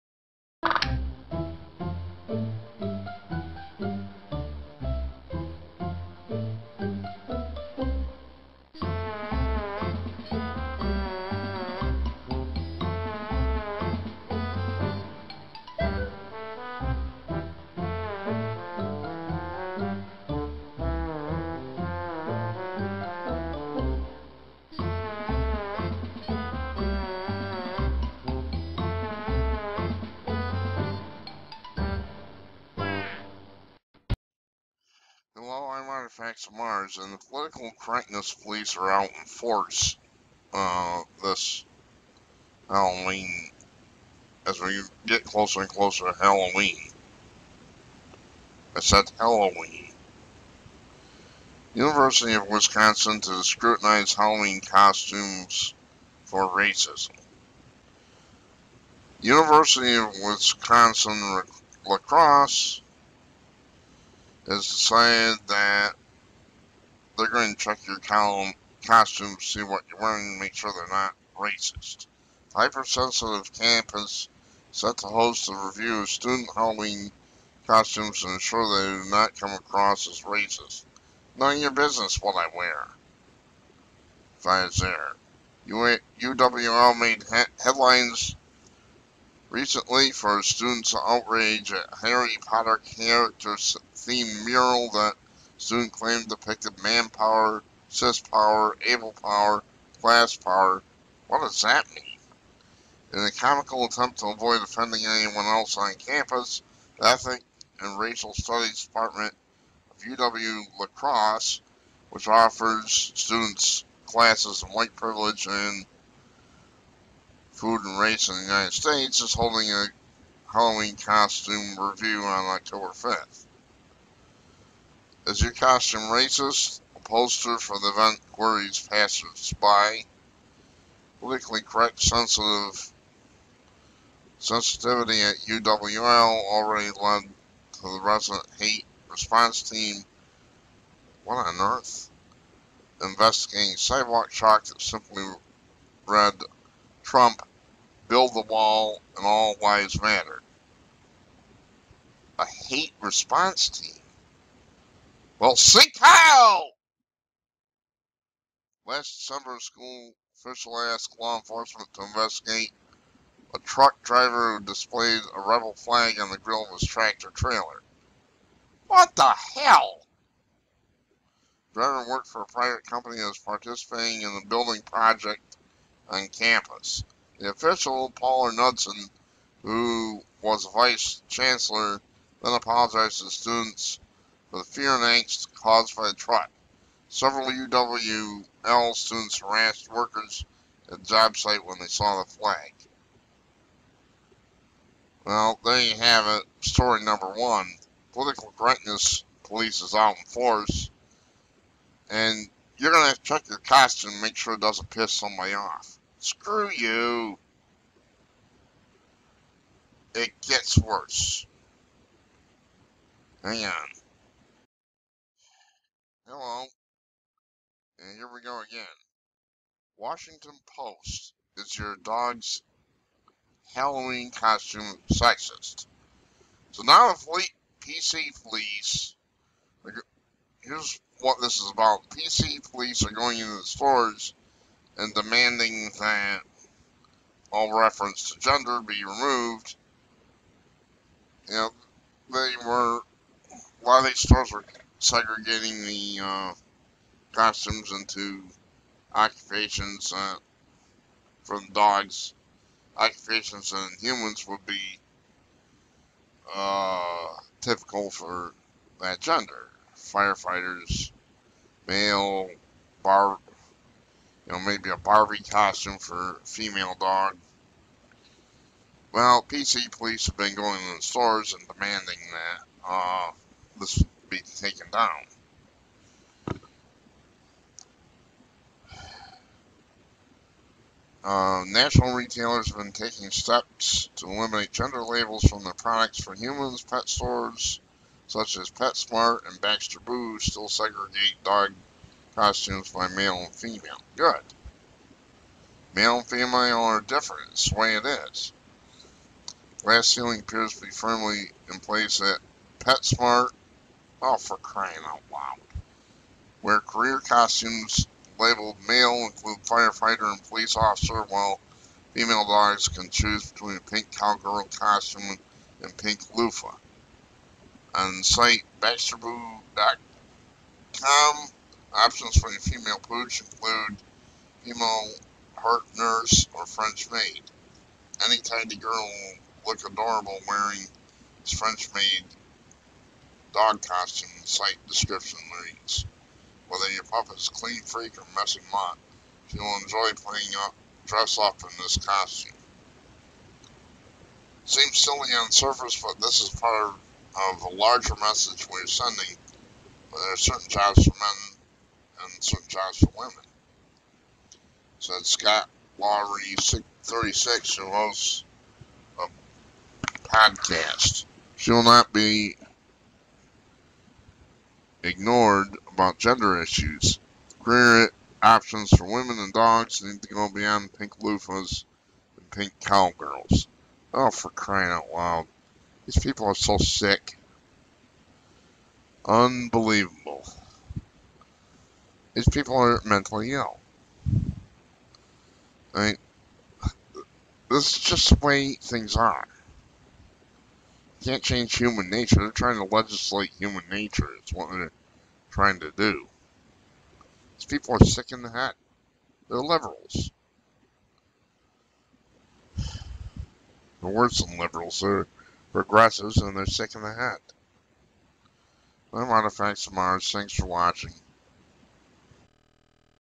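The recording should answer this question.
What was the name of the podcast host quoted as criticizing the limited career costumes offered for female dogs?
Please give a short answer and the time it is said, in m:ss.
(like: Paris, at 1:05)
Scott Lowry, at 5:55.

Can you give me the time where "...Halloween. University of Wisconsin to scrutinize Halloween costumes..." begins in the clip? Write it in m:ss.
0:49.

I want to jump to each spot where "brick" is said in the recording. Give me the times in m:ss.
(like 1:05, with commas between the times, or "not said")
not said.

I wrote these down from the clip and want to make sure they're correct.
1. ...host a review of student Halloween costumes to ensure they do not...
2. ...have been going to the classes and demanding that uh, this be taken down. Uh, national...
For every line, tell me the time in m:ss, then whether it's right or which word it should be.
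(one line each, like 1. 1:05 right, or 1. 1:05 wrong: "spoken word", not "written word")
1. 1:15 right
2. 4:30 wrong: "stores", not "classes".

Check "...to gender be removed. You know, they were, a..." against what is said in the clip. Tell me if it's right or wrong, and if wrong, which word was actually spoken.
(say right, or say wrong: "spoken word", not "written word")
right.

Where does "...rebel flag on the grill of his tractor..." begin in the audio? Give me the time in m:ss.
2:45.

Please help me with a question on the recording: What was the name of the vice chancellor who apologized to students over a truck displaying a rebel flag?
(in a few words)
Paula Knudson.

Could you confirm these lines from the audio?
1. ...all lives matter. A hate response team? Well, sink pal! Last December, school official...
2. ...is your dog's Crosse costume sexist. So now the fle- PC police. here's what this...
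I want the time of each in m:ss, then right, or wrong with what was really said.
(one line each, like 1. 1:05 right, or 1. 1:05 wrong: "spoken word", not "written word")
1. 2:29 right
2. 3:41 wrong: "Halloween", not "Crosse".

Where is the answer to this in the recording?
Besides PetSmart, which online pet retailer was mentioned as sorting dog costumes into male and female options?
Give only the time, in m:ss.
4:49.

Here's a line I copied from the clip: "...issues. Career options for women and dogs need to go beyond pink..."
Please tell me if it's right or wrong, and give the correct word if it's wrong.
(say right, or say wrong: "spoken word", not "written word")
right.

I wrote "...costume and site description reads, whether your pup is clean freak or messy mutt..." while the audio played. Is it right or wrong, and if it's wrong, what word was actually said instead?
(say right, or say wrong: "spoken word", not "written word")
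right.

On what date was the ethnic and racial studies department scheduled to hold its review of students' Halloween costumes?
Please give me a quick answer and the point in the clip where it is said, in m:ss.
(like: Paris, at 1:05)
October 5, at 2:02.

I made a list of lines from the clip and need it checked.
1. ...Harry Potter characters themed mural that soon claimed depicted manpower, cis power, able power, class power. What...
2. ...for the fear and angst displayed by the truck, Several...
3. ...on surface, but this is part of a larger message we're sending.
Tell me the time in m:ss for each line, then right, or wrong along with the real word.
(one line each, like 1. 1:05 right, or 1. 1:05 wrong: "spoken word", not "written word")
1. 1:32 right
2. 3:04 wrong: "caused", not "displayed"
3. 5:45 right.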